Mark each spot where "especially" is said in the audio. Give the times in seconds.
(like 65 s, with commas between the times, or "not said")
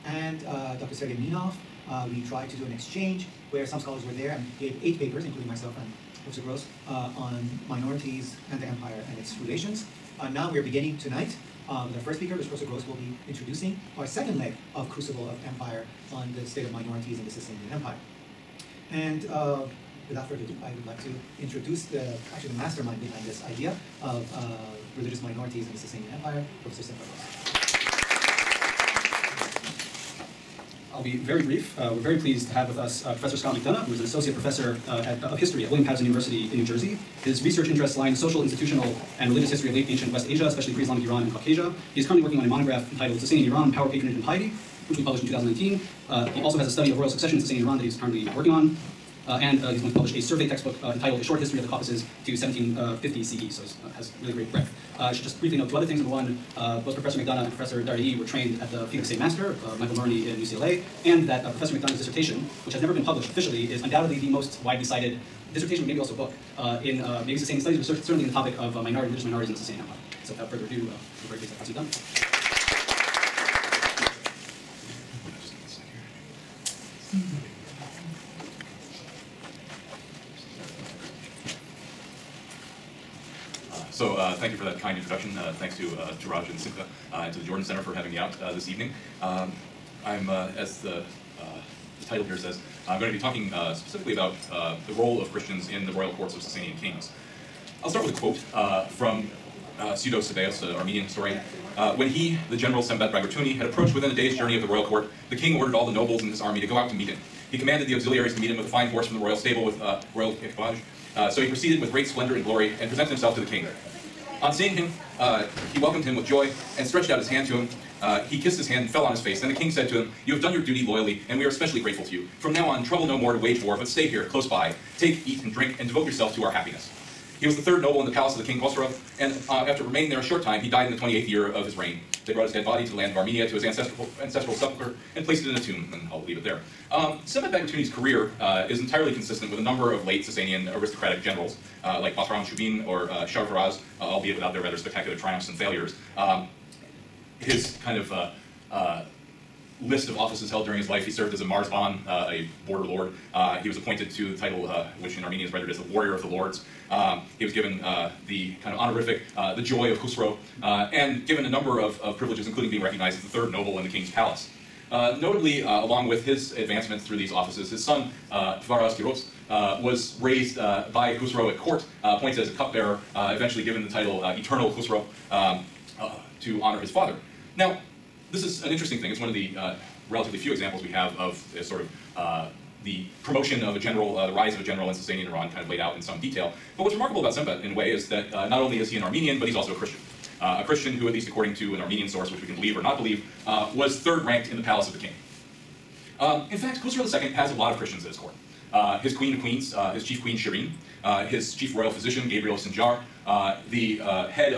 40 s, 121 s.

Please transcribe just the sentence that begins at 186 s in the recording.
But what's remarkable about Smbat, in a way, is that uh, not only is he an Armenian, but he's also a Christian.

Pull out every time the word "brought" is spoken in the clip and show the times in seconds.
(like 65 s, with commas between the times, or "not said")
132 s.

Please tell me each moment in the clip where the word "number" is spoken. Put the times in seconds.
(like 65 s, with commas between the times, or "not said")
55 s, 139 s, 161 s.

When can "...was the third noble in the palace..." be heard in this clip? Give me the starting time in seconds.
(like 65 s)
127 s.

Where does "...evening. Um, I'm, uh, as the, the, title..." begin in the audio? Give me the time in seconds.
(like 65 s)
88 s.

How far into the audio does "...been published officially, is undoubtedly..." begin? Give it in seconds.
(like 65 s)
62 s.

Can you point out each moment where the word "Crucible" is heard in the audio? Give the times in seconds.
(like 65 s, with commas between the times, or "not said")
14 s.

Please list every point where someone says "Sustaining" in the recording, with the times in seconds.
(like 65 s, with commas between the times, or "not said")
43 s, 47 s.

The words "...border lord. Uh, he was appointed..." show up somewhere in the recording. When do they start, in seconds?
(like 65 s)
152 s.